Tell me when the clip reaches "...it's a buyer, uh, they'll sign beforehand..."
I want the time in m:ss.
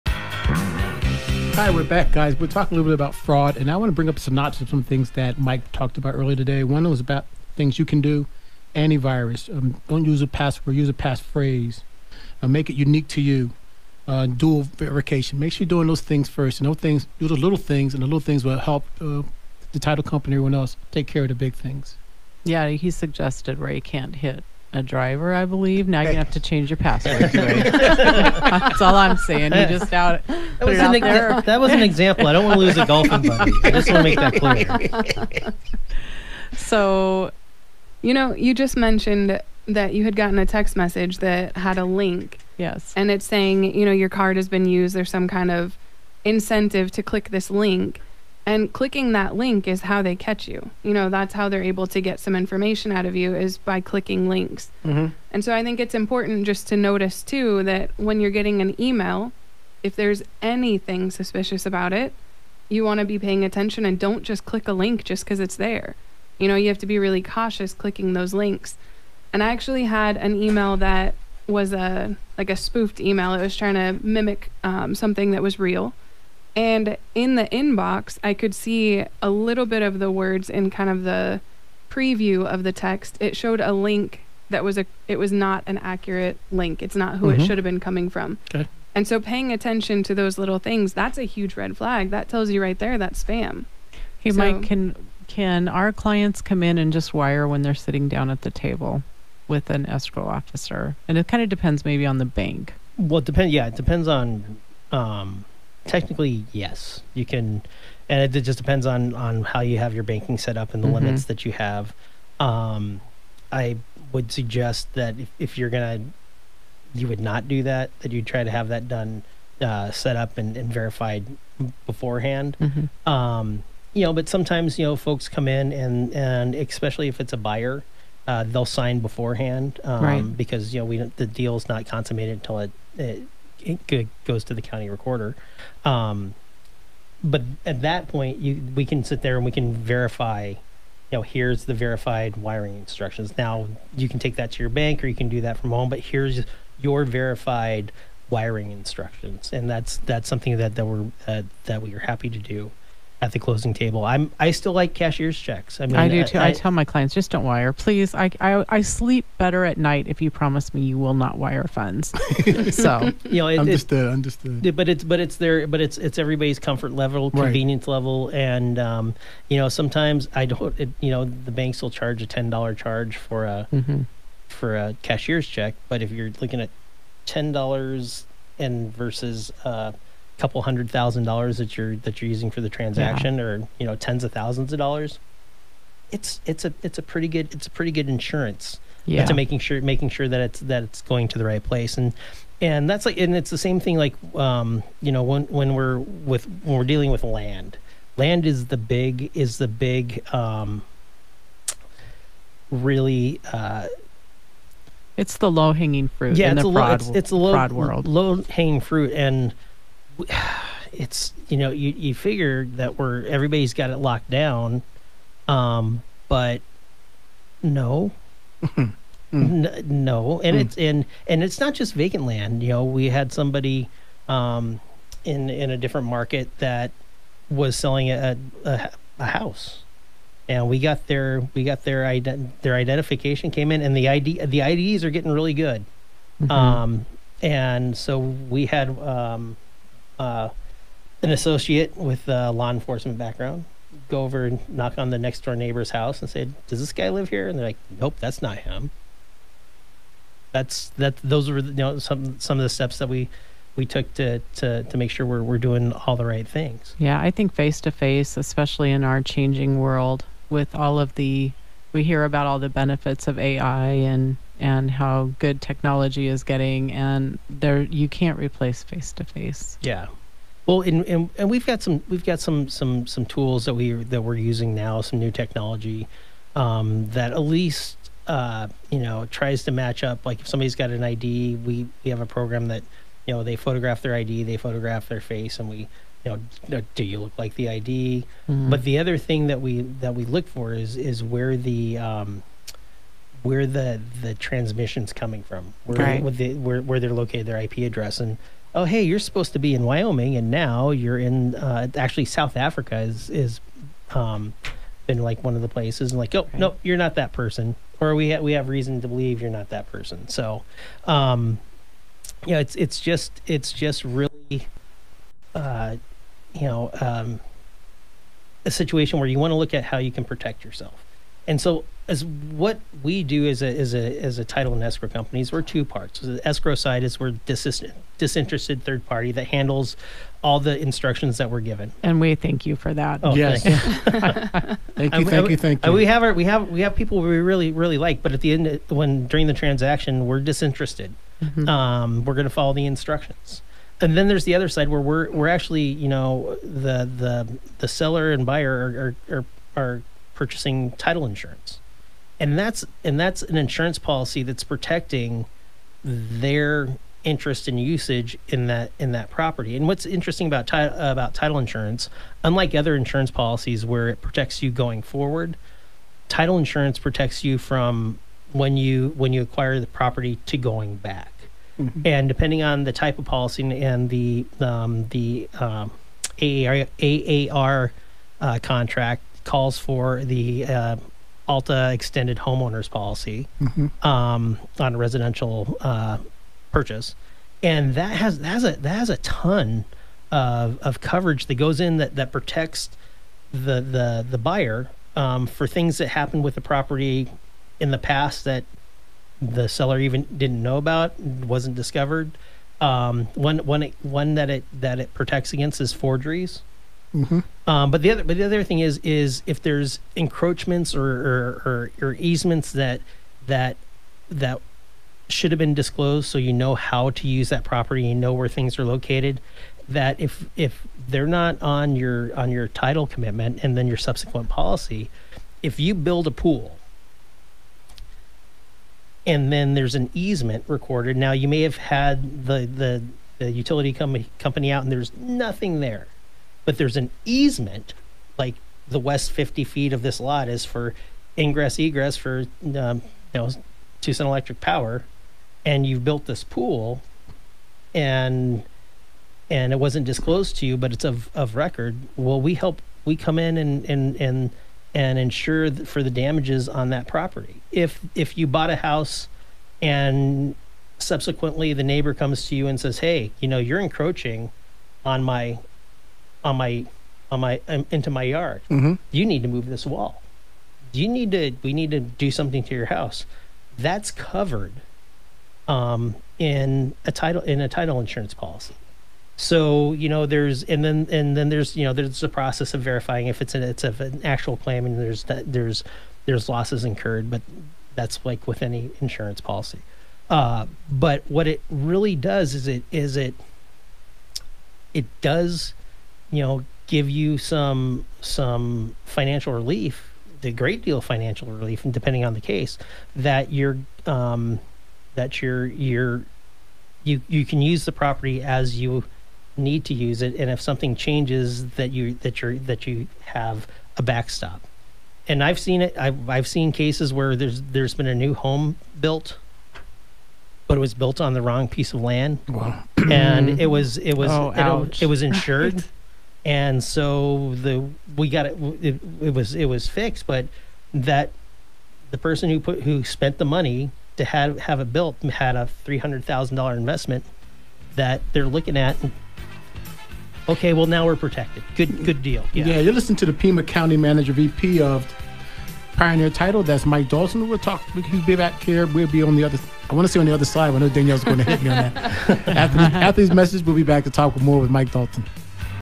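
2:07.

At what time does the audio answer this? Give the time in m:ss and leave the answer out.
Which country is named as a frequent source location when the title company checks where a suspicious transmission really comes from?
5:02.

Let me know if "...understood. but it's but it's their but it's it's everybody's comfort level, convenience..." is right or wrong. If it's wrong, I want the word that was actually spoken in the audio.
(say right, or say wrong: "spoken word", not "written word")
right.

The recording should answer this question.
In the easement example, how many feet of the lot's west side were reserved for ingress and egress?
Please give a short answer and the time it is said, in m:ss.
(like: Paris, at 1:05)
50 feet, at 7:19.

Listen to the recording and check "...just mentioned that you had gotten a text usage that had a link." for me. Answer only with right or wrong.
wrong.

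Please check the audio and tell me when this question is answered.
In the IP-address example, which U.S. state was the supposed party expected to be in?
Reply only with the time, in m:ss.
4:59.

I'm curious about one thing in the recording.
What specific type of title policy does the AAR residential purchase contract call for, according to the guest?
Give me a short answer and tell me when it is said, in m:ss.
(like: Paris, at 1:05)
ALTA extended homeowners policy, at 6:21.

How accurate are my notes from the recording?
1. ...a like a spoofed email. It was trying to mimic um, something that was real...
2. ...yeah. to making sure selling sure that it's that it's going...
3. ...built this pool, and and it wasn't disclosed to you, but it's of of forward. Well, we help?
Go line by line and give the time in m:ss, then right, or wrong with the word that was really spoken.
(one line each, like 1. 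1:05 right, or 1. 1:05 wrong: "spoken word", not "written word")
1. 1:11 right
2. 3:09 wrong: "making", not "selling"
3. 7:26 wrong: "record", not "forward".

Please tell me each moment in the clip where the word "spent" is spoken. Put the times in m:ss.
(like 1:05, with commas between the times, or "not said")
8:53.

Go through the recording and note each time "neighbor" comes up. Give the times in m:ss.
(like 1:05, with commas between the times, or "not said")
4:05, 7:41.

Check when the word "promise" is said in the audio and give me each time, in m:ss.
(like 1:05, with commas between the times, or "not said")
2:40.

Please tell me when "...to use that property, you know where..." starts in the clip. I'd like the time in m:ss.
6:57.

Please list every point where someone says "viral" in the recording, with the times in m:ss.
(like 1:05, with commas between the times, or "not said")
not said.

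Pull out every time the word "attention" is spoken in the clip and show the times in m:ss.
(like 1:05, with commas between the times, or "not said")
1:03, 1:29.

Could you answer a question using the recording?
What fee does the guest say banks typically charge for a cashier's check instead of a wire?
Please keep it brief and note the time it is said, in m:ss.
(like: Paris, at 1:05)
$10, at 2:52.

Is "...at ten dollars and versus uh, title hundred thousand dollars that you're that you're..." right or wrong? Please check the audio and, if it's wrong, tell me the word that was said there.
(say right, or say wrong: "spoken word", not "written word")
wrong: "couple", not "title".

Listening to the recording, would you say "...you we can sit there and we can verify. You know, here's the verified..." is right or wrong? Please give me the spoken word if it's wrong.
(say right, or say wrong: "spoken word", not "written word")
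right.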